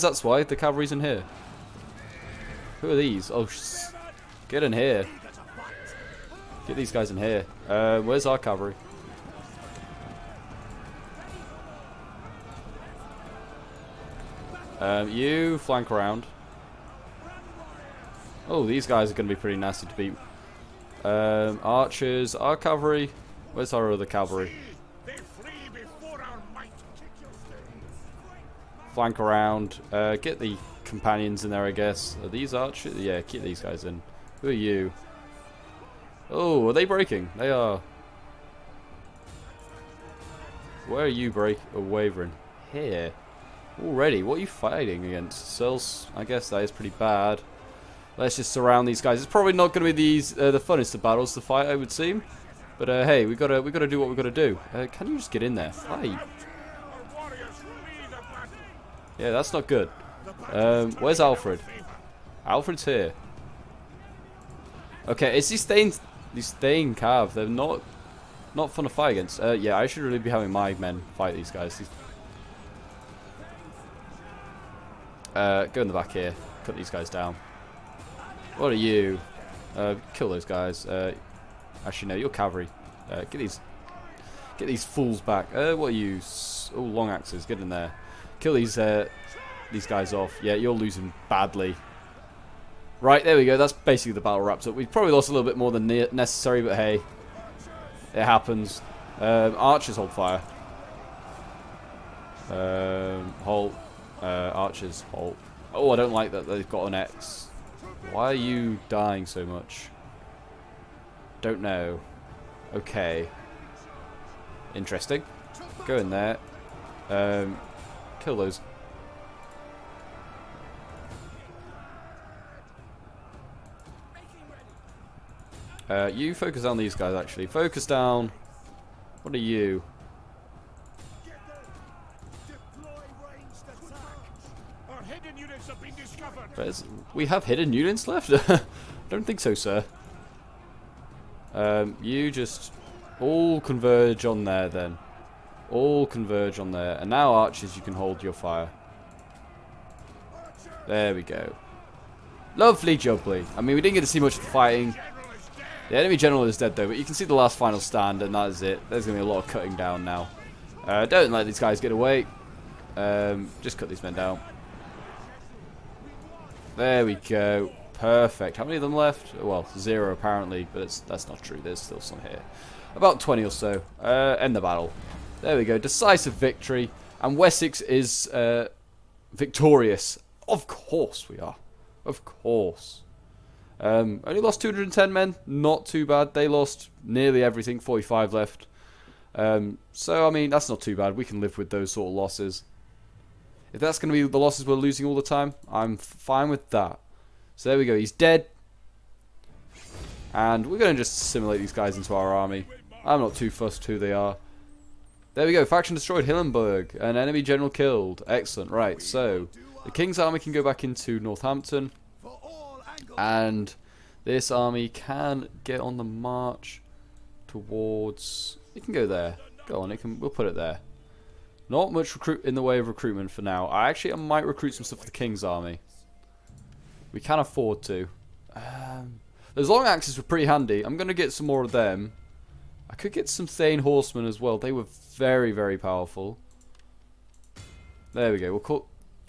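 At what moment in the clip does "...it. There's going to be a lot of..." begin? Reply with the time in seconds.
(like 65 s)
158 s.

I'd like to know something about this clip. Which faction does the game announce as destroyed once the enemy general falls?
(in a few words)
Hillenburg.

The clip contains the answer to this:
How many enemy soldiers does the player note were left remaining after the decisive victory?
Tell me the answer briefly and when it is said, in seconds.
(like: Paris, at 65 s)
45, at 187 s.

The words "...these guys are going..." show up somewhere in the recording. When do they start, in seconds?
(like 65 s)
18 s.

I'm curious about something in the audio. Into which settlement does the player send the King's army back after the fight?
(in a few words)
Northampton.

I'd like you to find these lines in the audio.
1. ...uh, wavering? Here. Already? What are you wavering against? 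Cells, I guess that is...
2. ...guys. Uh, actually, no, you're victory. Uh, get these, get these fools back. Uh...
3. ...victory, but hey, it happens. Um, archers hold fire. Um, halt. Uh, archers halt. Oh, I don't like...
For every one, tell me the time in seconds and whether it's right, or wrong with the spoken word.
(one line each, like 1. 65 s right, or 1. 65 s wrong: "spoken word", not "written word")
1. 41 s wrong: "fighting", not "wavering"
2. 80 s wrong: "cavalry", not "victory"
3. 95 s wrong: "necessary", not "victory".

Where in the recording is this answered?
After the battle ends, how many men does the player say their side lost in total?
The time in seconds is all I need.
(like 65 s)
184 s.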